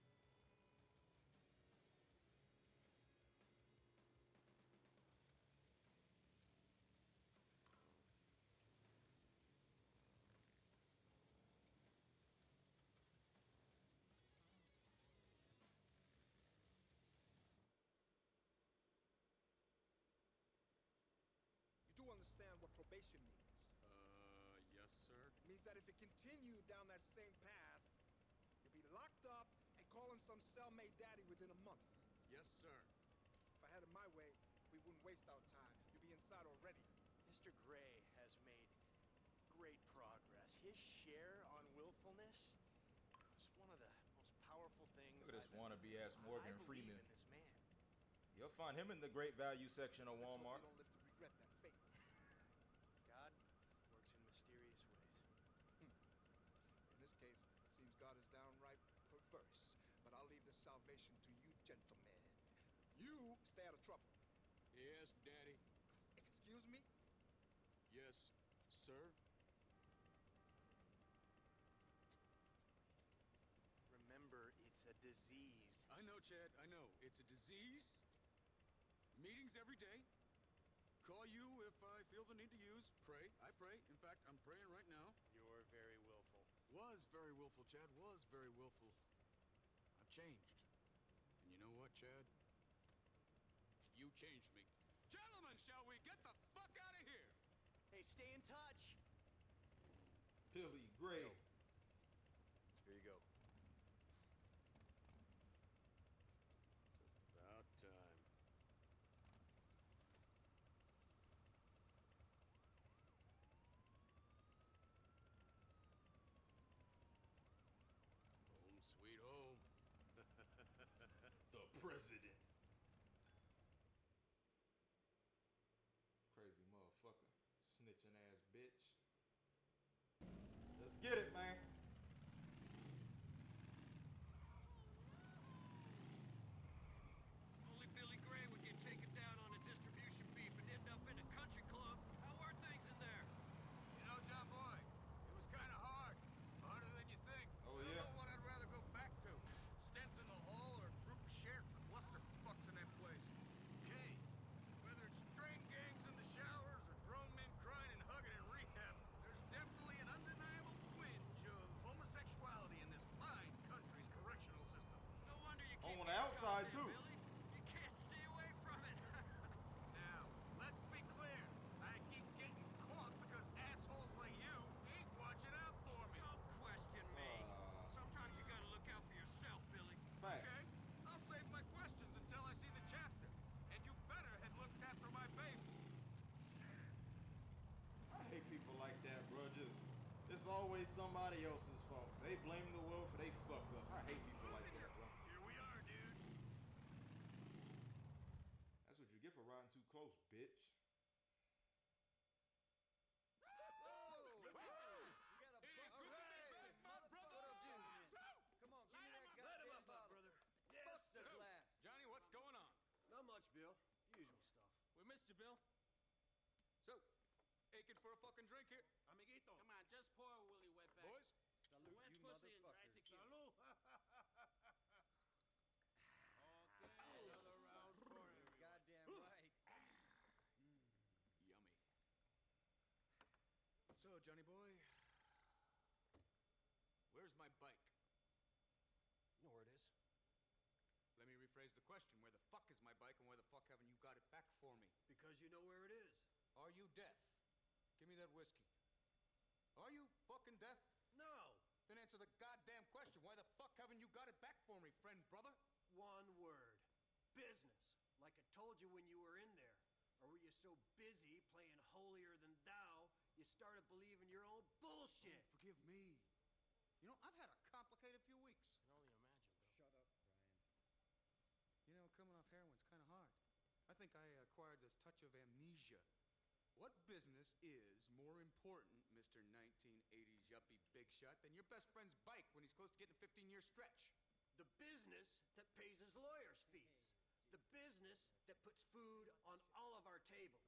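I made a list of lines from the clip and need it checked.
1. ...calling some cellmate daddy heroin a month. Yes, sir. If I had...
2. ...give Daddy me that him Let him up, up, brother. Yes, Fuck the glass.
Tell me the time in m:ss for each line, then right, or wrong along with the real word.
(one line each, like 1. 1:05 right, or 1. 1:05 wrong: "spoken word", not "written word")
1. 0:29 wrong: "within", not "heroin"
2. 3:28 wrong: "Light", not "Daddy".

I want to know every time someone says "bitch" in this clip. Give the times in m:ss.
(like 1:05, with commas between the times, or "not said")
2:08, 3:20.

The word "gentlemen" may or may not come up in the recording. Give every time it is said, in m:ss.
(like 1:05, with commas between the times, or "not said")
1:01, 1:35.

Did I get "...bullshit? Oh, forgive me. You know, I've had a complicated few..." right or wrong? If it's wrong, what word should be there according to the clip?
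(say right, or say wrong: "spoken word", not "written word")
right.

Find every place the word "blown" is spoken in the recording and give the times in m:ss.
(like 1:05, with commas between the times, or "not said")
not said.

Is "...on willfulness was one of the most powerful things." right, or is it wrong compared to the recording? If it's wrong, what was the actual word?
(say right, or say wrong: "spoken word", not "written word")
right.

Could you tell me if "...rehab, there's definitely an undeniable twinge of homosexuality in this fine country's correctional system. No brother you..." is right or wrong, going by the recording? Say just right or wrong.
wrong.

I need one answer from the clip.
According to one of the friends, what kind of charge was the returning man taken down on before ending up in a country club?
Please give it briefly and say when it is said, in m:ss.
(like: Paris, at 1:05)
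distribution, at 2:19.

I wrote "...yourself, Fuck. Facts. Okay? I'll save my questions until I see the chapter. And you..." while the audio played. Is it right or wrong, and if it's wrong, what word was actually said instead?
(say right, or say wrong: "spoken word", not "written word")
wrong: "Billy", not "Fuck".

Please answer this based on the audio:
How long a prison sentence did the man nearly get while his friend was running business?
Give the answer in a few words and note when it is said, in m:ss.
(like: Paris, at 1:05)
15 years, at 4:43.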